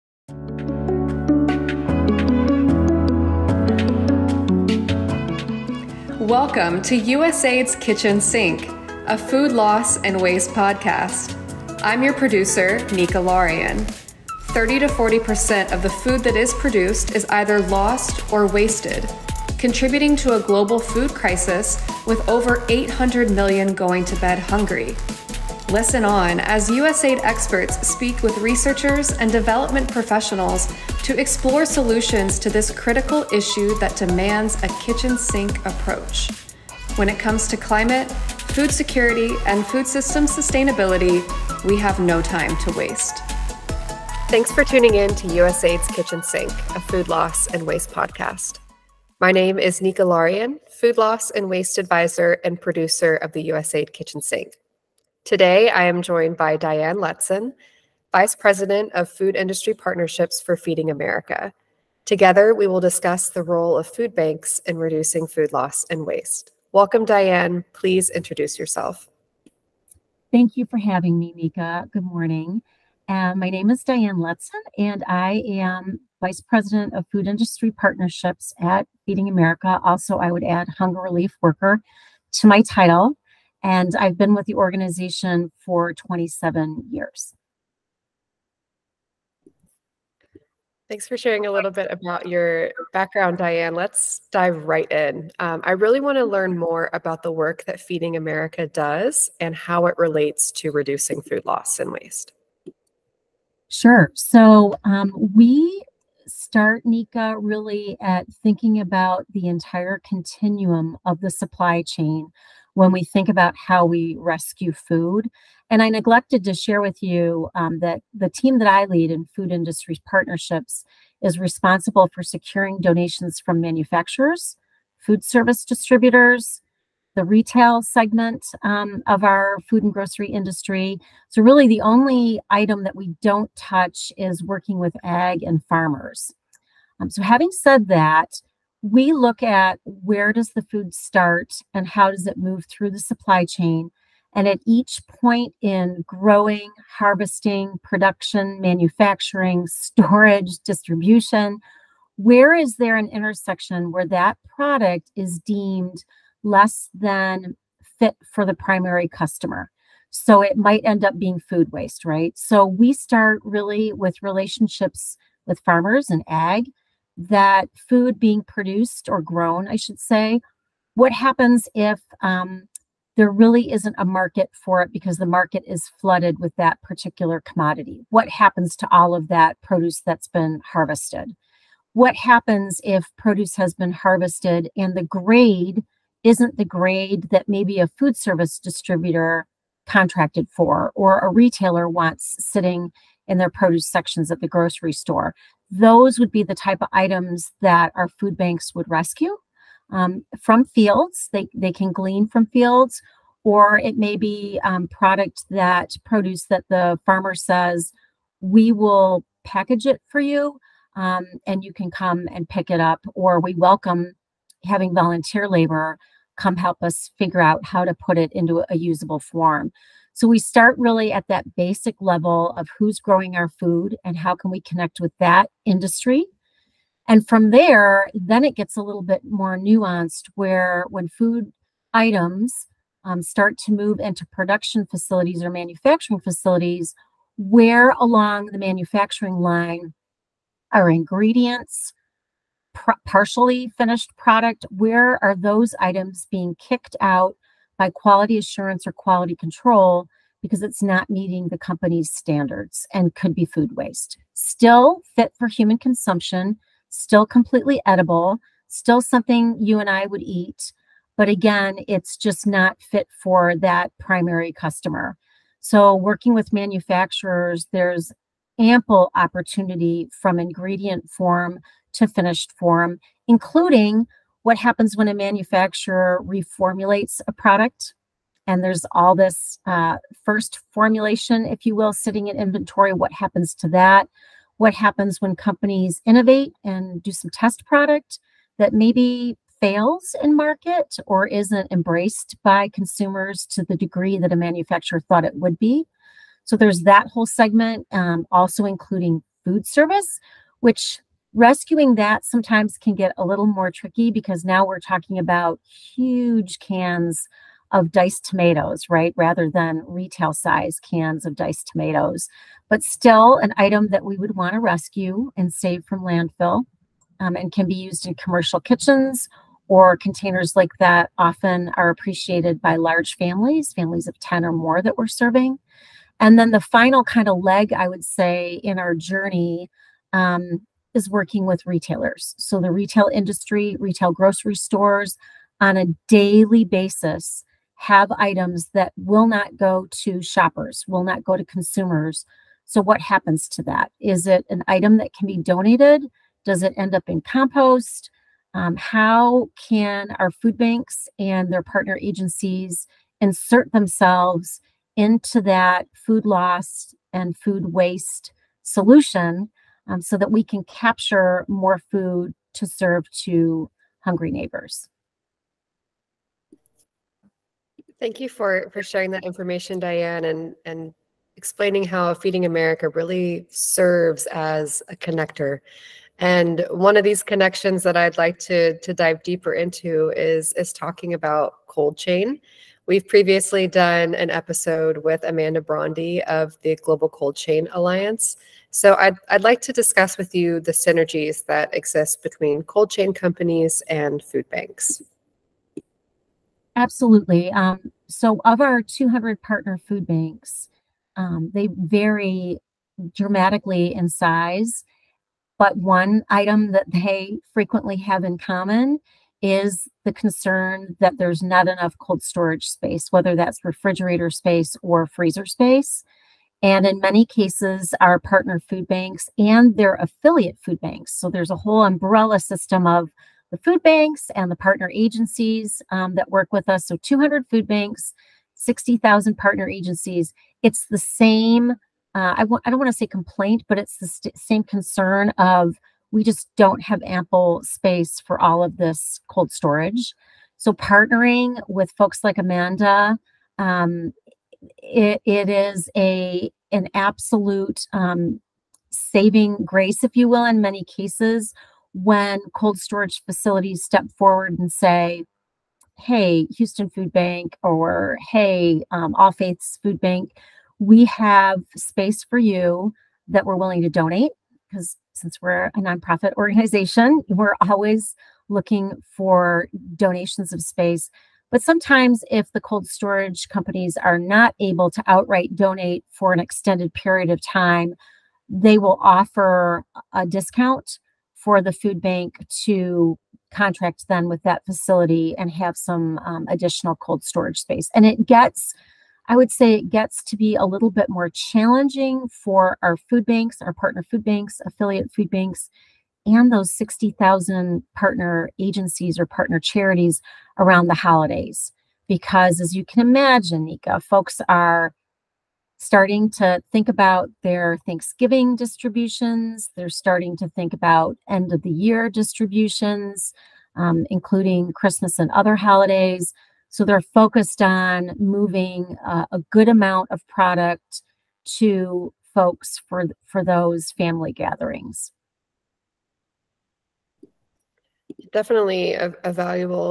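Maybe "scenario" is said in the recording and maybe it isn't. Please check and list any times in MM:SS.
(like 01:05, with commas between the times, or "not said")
not said.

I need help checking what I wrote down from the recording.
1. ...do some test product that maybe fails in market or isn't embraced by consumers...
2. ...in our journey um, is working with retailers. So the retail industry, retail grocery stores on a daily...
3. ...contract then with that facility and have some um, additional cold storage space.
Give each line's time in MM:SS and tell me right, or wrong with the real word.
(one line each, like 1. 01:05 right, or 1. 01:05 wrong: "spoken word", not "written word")
1. 04:47 right
2. 05:28 right
3. 08:03 right.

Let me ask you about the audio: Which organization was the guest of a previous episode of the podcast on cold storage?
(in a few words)
Global Cold Chain Alliance.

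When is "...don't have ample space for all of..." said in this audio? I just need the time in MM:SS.
07:16.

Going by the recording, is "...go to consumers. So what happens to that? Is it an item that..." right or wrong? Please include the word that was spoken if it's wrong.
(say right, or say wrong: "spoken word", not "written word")
right.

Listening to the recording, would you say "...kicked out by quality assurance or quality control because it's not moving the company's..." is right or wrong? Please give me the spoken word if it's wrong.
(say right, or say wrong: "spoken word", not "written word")
wrong: "meeting", not "moving".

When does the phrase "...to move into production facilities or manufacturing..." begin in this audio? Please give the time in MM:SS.
03:53.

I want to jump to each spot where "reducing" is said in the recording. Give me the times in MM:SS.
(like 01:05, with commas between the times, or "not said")
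01:04, 01:40.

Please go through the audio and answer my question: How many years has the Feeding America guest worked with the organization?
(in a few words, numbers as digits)
27.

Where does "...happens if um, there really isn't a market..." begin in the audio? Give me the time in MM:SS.
02:51.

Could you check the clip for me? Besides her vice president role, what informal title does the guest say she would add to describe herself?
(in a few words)
Hunger Relief Worker.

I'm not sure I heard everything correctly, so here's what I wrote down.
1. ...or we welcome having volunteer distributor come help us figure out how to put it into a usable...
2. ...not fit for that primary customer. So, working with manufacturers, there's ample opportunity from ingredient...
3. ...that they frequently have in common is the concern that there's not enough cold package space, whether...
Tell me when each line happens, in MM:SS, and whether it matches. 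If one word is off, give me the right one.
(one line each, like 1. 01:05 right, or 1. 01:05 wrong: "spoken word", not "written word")
1. 03:33 wrong: "labor", not "distributor"
2. 04:22 right
3. 06:46 wrong: "storage", not "package".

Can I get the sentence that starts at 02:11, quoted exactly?
So, really, the only item that we don't touch is working with ag and farmers.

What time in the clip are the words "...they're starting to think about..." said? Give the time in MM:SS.
08:29.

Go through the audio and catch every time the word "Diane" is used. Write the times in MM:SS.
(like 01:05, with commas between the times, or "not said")
00:56, 01:07, 01:13, 01:33, 06:09.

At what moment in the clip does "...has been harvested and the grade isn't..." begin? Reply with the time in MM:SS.
03:03.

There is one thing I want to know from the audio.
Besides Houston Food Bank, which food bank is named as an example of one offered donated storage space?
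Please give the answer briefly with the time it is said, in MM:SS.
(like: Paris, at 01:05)
All Faiths Food Bank, at 07:39.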